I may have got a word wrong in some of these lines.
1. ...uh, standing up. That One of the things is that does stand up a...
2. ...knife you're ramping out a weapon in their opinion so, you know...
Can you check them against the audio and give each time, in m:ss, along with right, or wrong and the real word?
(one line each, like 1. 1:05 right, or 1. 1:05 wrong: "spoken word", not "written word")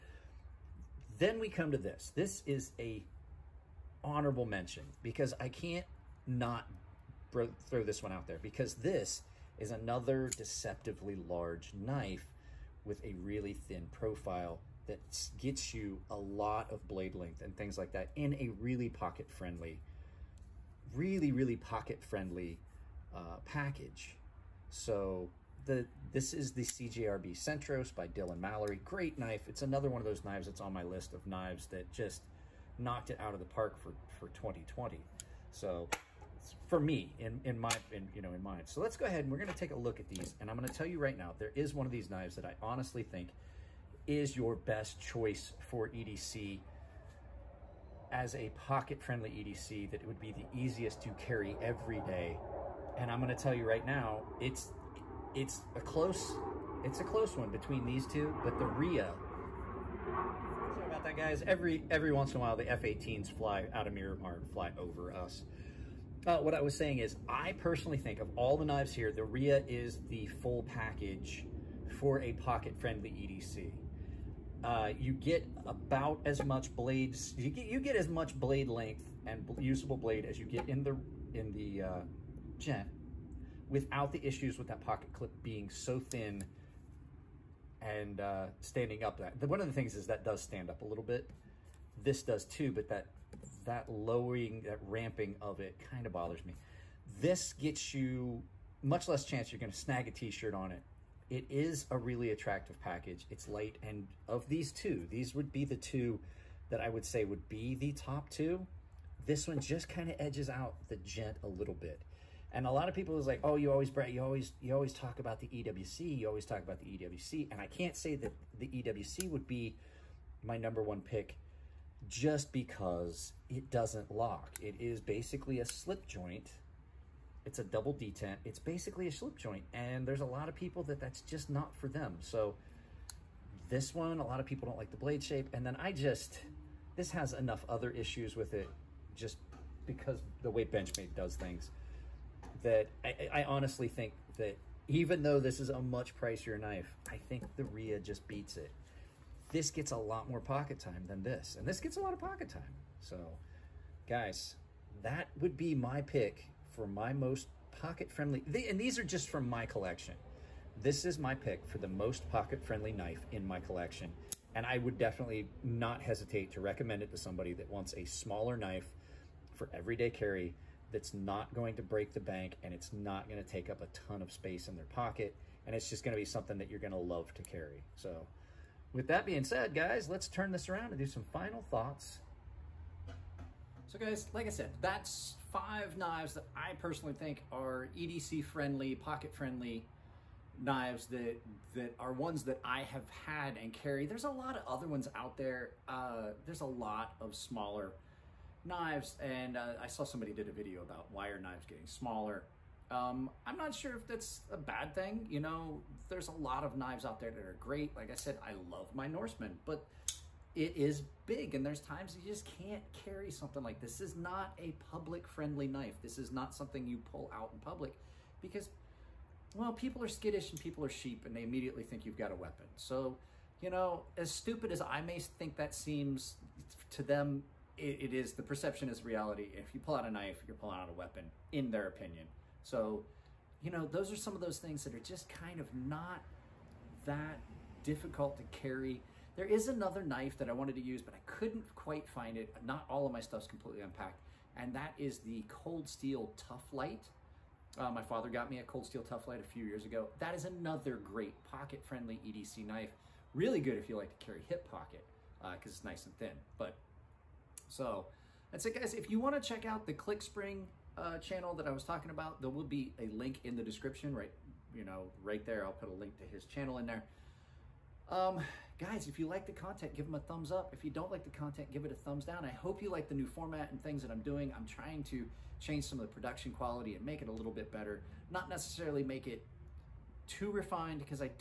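1. 1:28 right
2. 3:50 wrong: "pulling", not "ramping".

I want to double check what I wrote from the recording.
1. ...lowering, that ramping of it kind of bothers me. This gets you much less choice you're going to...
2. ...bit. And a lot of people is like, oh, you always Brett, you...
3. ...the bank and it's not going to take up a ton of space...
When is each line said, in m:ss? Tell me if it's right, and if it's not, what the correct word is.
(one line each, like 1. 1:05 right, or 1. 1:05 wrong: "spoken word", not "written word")
1. 1:33 wrong: "chance", not "choice"
2. 1:51 right
3. 2:52 right.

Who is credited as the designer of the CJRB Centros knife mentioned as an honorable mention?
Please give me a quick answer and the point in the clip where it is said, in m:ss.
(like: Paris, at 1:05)
Dylan Mallory, at 0:28.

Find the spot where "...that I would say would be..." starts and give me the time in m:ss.
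1:46.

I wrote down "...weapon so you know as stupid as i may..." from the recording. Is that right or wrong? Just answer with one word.
right.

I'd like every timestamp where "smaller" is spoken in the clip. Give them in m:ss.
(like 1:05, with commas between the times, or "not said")
2:48, 3:17, 3:21.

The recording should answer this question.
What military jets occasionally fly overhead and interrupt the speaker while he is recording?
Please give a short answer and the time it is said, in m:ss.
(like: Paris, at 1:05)
F18s, at 1:02.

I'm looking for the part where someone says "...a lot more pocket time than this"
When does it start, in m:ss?
2:29.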